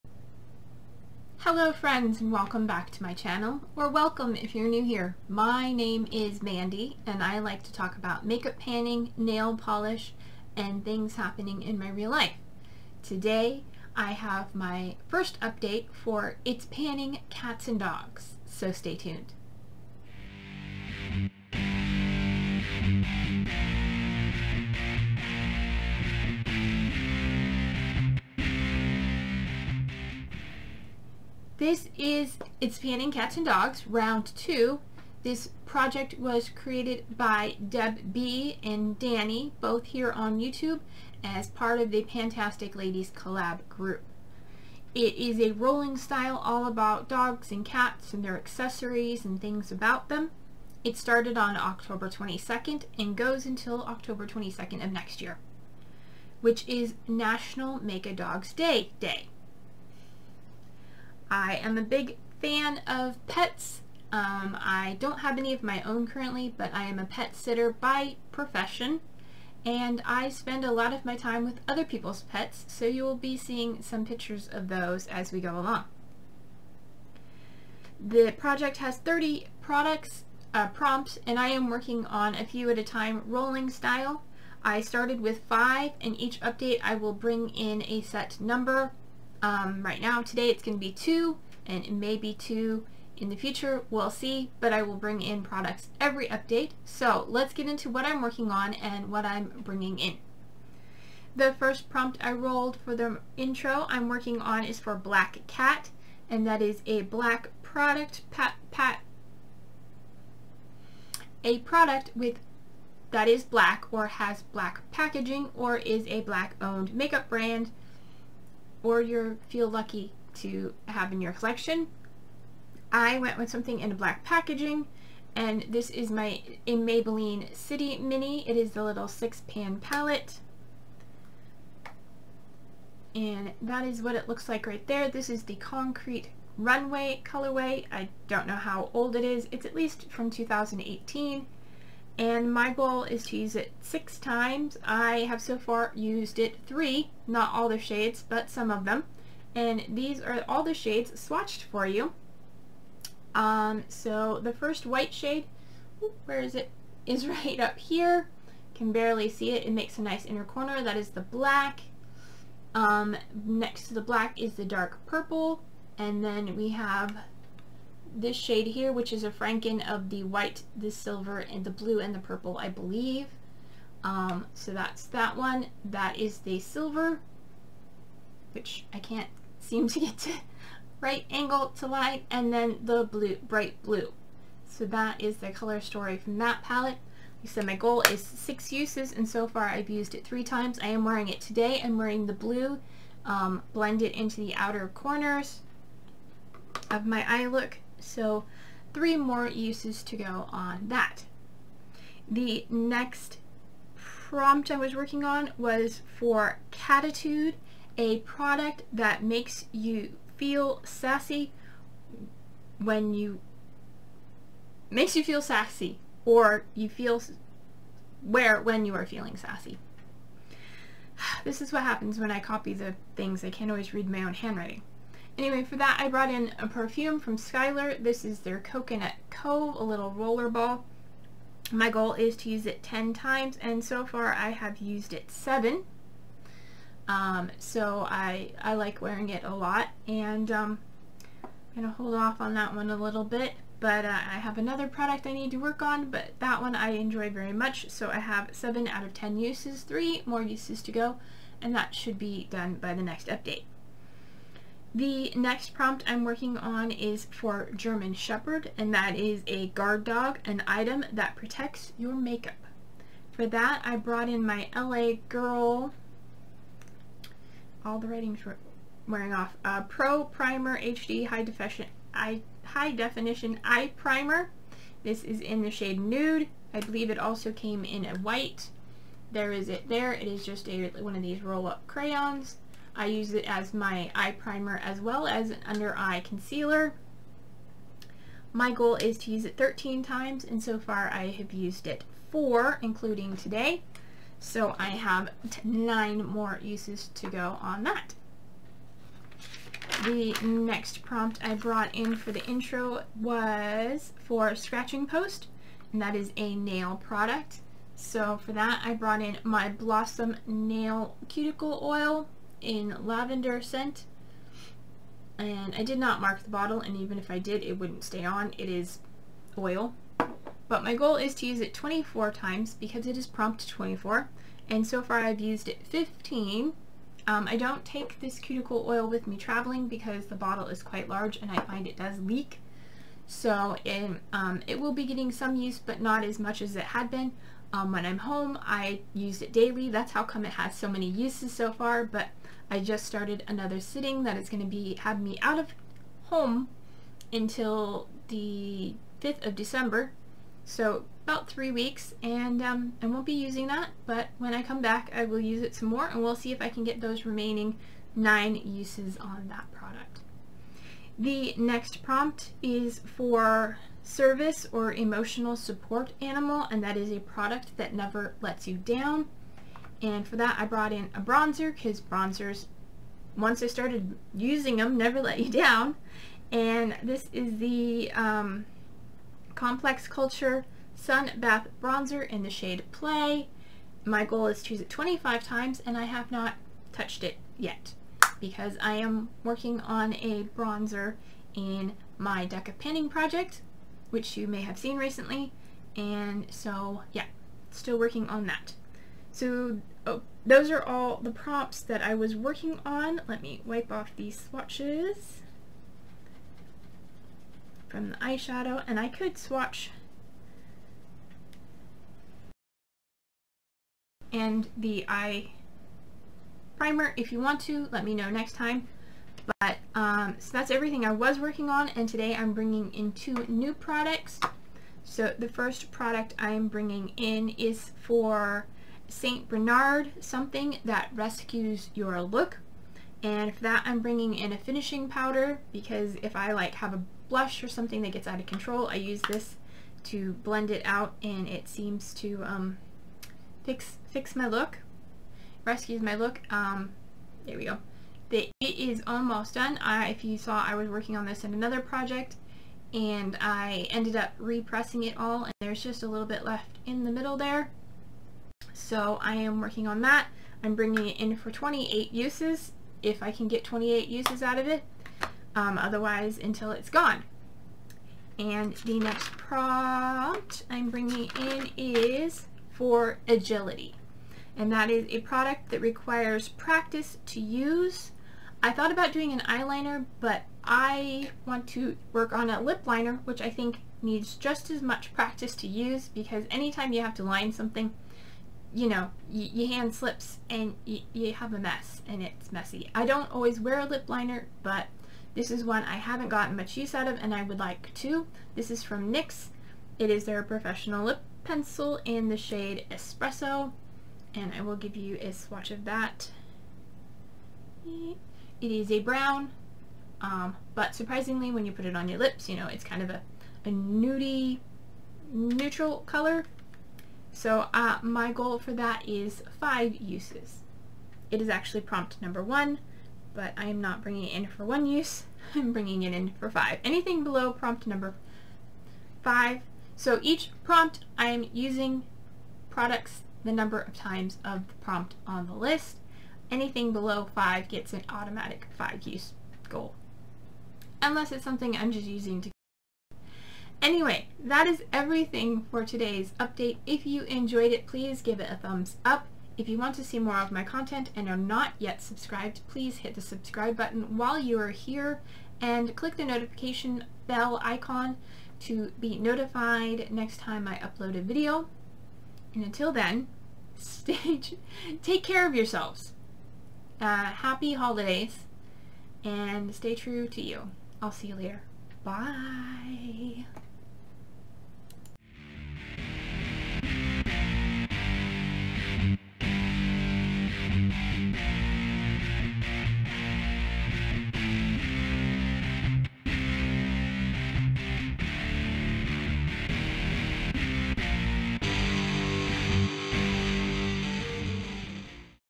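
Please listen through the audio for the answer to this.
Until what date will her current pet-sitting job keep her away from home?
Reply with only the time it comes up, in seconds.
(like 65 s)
349 s.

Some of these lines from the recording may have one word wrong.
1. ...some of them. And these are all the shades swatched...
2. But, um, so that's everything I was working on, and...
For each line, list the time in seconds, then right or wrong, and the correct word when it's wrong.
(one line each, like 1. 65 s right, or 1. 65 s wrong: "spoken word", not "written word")
1. 148 s right
2. 419 s right.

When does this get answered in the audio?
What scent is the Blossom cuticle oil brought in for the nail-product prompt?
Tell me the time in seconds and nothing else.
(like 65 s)
313 s.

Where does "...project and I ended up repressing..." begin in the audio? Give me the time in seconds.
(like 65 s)
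451 s.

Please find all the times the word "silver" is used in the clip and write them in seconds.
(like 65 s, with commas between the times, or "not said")
170 s, 176 s.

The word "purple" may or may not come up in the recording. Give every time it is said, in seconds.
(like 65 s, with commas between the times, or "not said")
165 s, 172 s.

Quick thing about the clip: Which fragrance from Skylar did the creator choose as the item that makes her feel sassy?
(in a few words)
Coconut Cove.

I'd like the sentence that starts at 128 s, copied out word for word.
It is the little six pan palette.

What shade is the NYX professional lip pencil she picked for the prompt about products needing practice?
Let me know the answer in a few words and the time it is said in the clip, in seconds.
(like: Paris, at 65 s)
Espresso, at 502 s.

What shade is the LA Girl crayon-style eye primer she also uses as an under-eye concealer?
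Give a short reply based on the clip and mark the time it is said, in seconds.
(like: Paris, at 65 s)
Nude, at 276 s.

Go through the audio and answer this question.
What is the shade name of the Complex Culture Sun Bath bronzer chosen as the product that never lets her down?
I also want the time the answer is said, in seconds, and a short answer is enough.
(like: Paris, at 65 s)
Play, at 382 s.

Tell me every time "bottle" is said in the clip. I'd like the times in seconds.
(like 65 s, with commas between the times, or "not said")
316 s, 330 s.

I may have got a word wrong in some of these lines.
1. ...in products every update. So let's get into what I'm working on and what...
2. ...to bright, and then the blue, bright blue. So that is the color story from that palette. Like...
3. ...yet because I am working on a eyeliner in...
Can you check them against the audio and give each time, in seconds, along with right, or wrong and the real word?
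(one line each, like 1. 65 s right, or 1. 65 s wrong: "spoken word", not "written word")
1. 95 s right
2. 181 s wrong: "light", not "bright"
3. 387 s wrong: "bronzer", not "eyeliner".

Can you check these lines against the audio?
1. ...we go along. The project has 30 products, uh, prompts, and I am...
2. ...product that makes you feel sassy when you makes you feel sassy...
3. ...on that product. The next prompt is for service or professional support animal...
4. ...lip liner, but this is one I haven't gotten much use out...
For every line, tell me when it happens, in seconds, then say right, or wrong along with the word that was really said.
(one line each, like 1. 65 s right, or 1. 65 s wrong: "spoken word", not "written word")
1. 75 s right
2. 208 s right
3. 359 s wrong: "emotional", not "professional"
4. 493 s right.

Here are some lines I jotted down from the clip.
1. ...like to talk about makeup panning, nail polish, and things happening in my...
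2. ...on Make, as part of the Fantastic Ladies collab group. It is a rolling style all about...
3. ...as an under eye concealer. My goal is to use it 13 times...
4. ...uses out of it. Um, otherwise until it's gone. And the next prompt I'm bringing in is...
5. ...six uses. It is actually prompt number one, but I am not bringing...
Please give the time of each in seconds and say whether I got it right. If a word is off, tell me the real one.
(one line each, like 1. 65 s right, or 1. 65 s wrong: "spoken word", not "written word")
1. 7 s right
2. 40 s wrong: "YouTube", not "Make"
3. 285 s right
4. 464 s right
5. 519 s wrong: "five", not "six".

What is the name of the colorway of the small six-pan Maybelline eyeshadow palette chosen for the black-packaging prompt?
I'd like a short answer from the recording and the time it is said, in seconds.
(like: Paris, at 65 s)
Concrete Runway, at 135 s.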